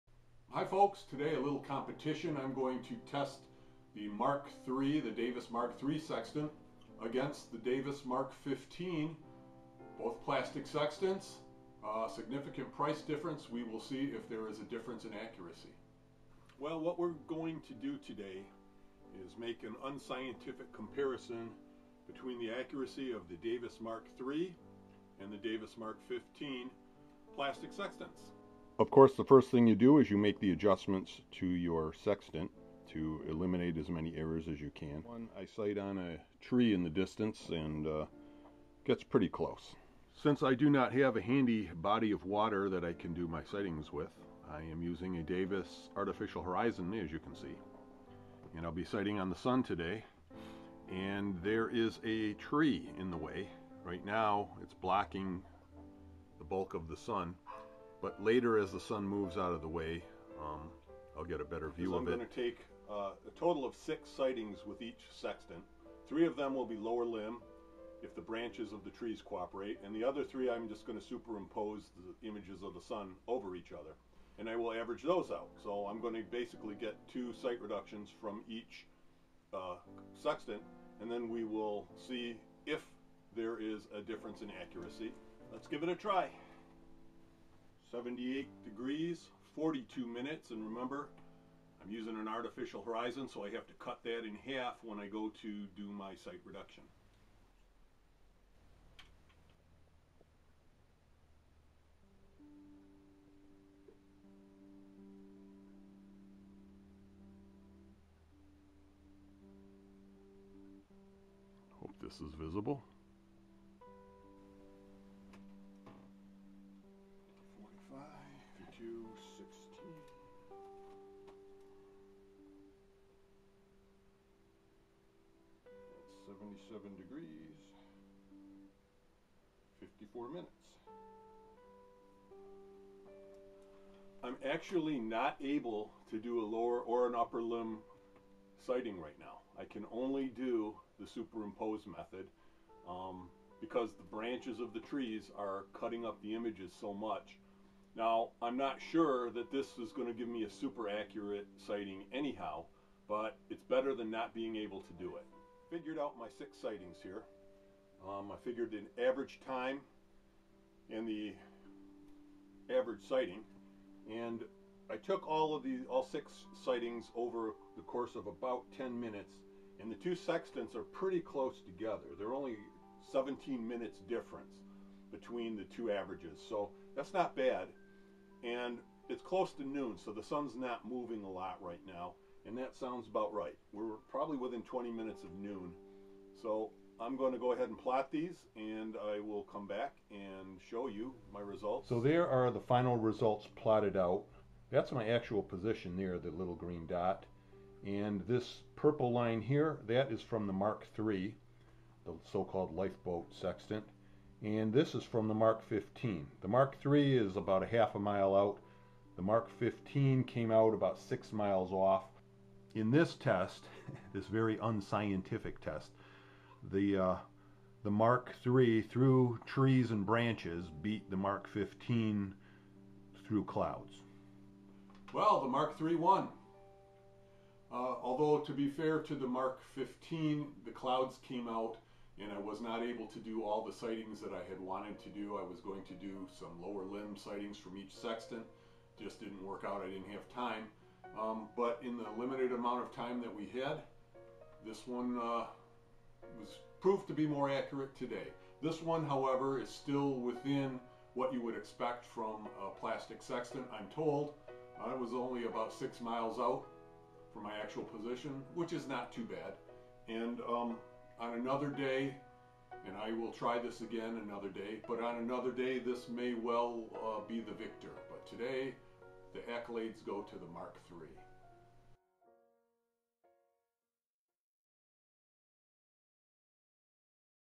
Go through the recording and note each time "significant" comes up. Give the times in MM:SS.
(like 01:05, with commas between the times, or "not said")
00:12.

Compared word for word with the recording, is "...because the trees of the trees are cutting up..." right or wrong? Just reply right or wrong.
wrong.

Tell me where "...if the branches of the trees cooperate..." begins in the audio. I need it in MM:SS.
01:08.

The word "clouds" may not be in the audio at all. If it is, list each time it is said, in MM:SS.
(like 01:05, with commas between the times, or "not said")
03:43, 03:50.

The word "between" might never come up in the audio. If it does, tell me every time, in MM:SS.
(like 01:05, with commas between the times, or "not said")
00:22, 02:55.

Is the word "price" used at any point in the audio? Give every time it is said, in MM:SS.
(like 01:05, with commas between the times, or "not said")
00:12.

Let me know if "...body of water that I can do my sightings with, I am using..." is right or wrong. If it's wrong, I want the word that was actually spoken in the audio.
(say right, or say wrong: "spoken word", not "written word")
right.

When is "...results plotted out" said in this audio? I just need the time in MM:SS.
03:12.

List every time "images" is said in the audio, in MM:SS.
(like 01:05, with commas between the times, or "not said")
01:12, 02:26.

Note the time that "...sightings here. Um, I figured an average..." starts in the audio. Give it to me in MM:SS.
02:36.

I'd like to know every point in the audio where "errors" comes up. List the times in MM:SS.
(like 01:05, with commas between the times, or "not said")
00:34.